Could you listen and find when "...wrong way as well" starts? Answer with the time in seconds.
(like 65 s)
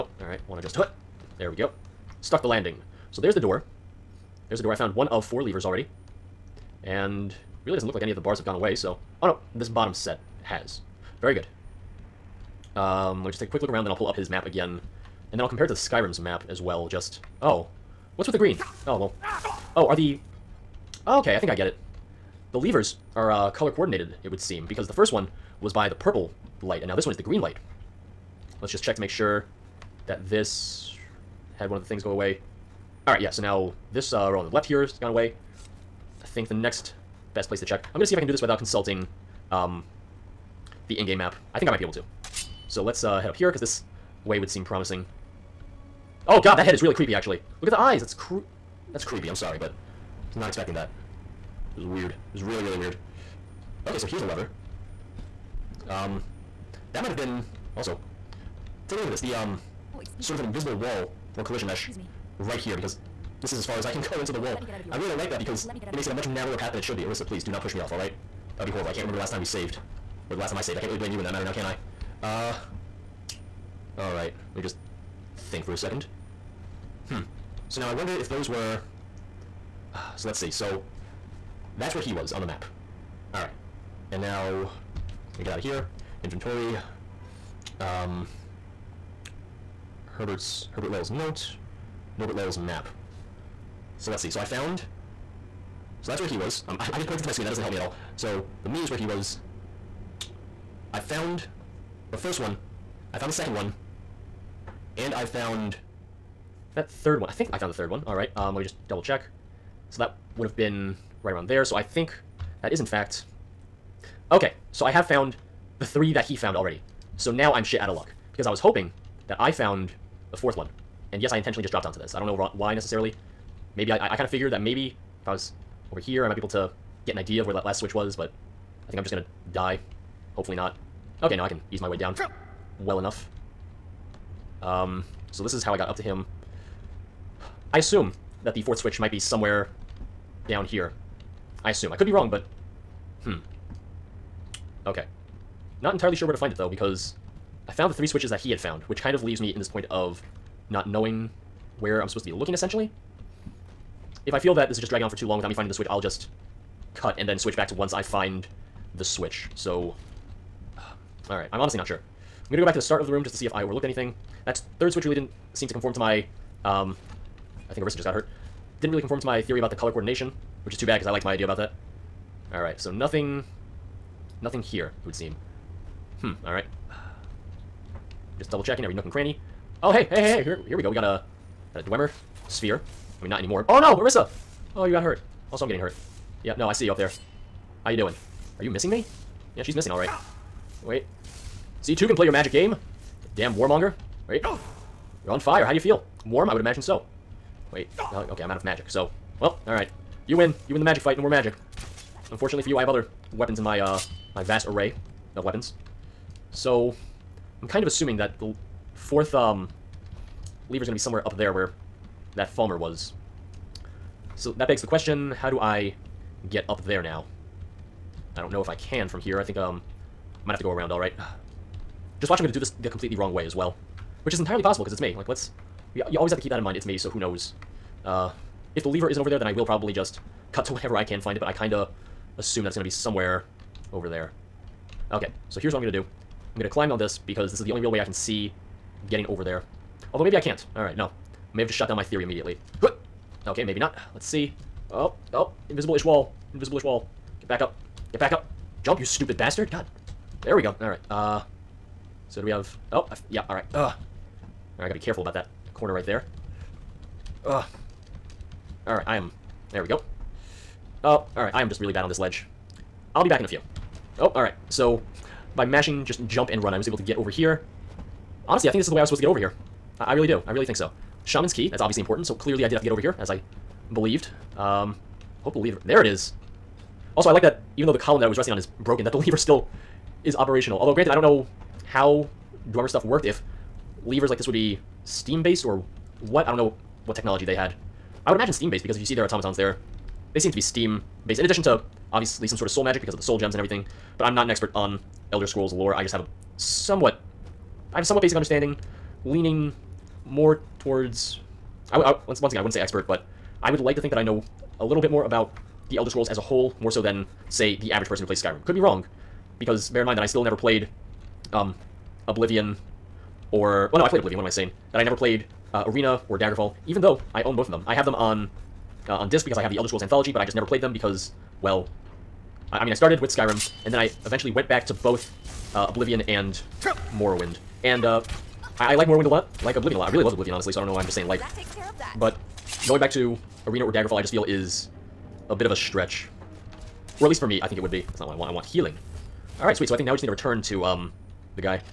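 223 s.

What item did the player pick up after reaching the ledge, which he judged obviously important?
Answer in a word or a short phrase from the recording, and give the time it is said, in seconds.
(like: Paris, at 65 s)
Shaman's Key, at 271 s.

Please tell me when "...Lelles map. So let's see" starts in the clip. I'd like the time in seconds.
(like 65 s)
92 s.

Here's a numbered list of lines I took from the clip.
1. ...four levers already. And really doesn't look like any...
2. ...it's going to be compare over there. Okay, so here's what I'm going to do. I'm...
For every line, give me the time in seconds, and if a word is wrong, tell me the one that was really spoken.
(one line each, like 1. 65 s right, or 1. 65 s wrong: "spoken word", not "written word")
1. 5 s right
2. 232 s wrong: "somewhere", not "compare".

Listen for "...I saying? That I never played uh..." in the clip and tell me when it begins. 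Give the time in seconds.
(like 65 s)
314 s.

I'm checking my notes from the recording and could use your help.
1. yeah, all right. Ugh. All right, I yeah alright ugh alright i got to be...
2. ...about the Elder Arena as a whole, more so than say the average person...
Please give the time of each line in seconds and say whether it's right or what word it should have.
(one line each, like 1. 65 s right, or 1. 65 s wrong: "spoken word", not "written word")
1. 253 s right
2. 305 s wrong: "Scrolls", not "Arena".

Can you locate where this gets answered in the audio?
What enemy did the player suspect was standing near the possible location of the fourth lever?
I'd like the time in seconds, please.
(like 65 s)
212 s.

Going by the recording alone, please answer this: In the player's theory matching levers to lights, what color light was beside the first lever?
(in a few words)
Purple.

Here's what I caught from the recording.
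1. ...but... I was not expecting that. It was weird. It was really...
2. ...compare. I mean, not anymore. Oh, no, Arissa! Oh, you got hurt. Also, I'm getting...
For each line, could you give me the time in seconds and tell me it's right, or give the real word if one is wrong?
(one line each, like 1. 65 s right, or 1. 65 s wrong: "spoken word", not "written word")
1. 49 s right
2. 182 s wrong: "sphere", not "compare".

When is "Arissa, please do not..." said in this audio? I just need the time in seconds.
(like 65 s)
67 s.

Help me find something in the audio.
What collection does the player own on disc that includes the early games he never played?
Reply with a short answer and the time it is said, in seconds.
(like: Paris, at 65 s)
Elder Scrolls Anthology, at 319 s.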